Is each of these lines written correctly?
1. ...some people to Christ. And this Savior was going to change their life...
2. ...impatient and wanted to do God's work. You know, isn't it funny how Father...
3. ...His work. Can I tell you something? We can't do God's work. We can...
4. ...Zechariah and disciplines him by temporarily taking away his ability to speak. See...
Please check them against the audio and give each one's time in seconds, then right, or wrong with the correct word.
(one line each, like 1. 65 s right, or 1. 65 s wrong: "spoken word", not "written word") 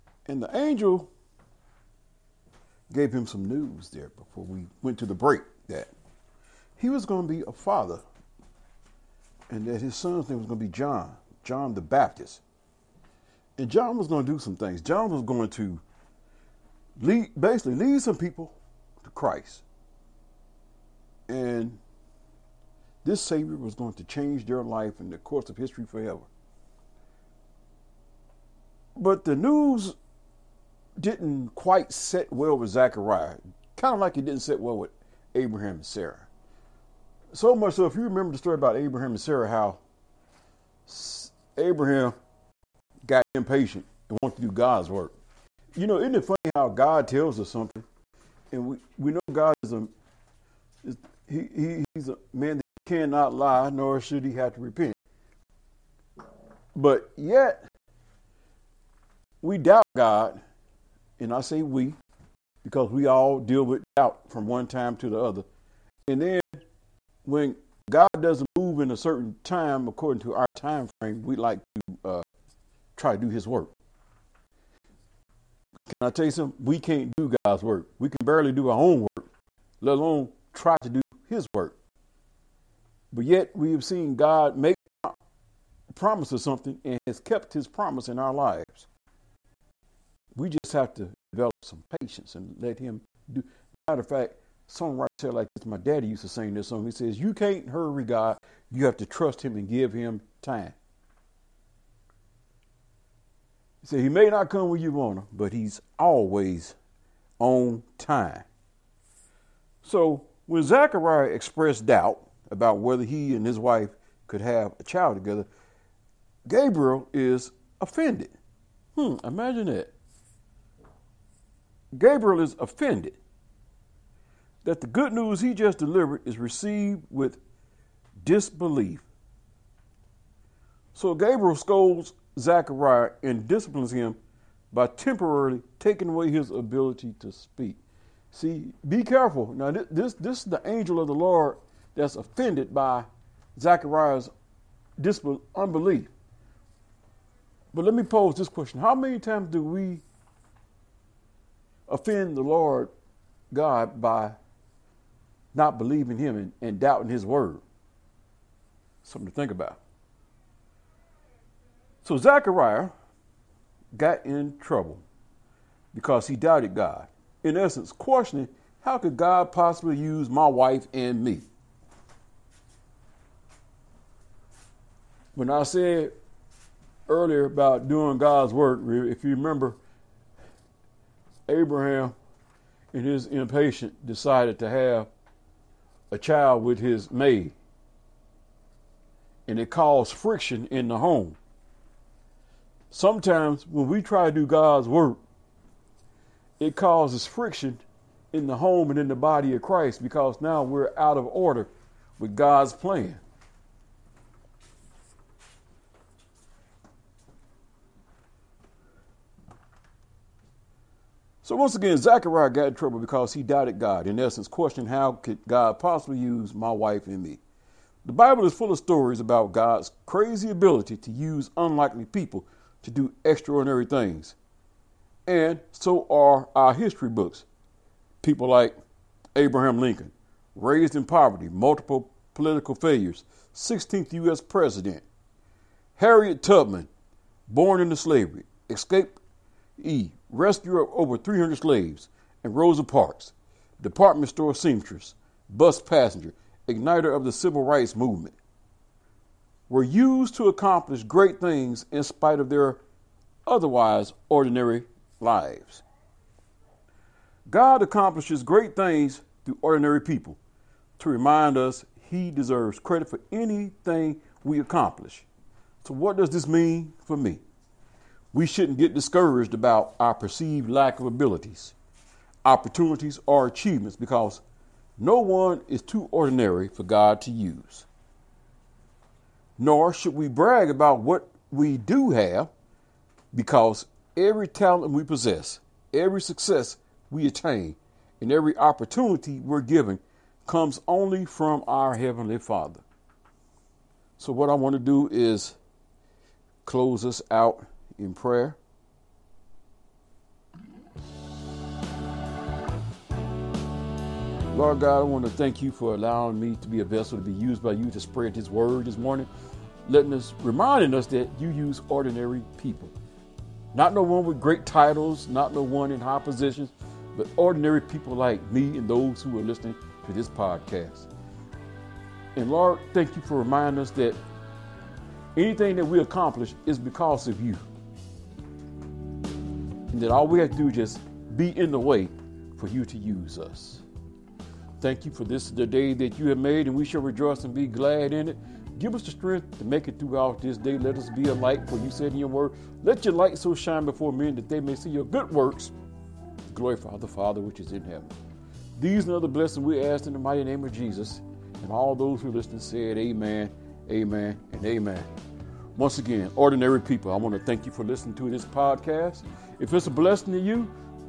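1. 18 s right
2. 43 s wrong: "God", not "Father"
3. 73 s right
4. 132 s right.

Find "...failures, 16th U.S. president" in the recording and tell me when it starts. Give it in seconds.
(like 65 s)
232 s.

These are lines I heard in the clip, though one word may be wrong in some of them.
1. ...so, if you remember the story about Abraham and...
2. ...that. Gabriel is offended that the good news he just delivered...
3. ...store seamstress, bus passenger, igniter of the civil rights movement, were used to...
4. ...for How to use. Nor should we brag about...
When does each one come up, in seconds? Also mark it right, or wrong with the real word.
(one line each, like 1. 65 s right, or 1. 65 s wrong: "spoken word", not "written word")
1. 37 s right
2. 119 s right
3. 244 s right
4. 276 s wrong: "God", not "How".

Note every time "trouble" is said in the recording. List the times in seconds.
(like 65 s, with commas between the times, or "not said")
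164 s, 212 s.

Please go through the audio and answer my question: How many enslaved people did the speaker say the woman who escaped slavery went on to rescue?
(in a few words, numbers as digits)
Over 300.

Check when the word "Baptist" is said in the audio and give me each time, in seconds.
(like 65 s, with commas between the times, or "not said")
11 s.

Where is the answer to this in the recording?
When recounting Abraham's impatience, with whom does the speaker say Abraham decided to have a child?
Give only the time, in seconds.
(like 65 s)
186 s.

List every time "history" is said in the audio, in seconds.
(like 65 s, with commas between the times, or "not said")
25 s, 226 s.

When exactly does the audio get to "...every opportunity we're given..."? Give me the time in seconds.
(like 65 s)
288 s.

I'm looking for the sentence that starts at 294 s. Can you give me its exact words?
So, what I want to do is close us out in prayer.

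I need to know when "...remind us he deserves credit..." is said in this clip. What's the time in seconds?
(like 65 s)
261 s.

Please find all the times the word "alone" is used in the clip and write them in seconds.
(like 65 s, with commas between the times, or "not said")
79 s.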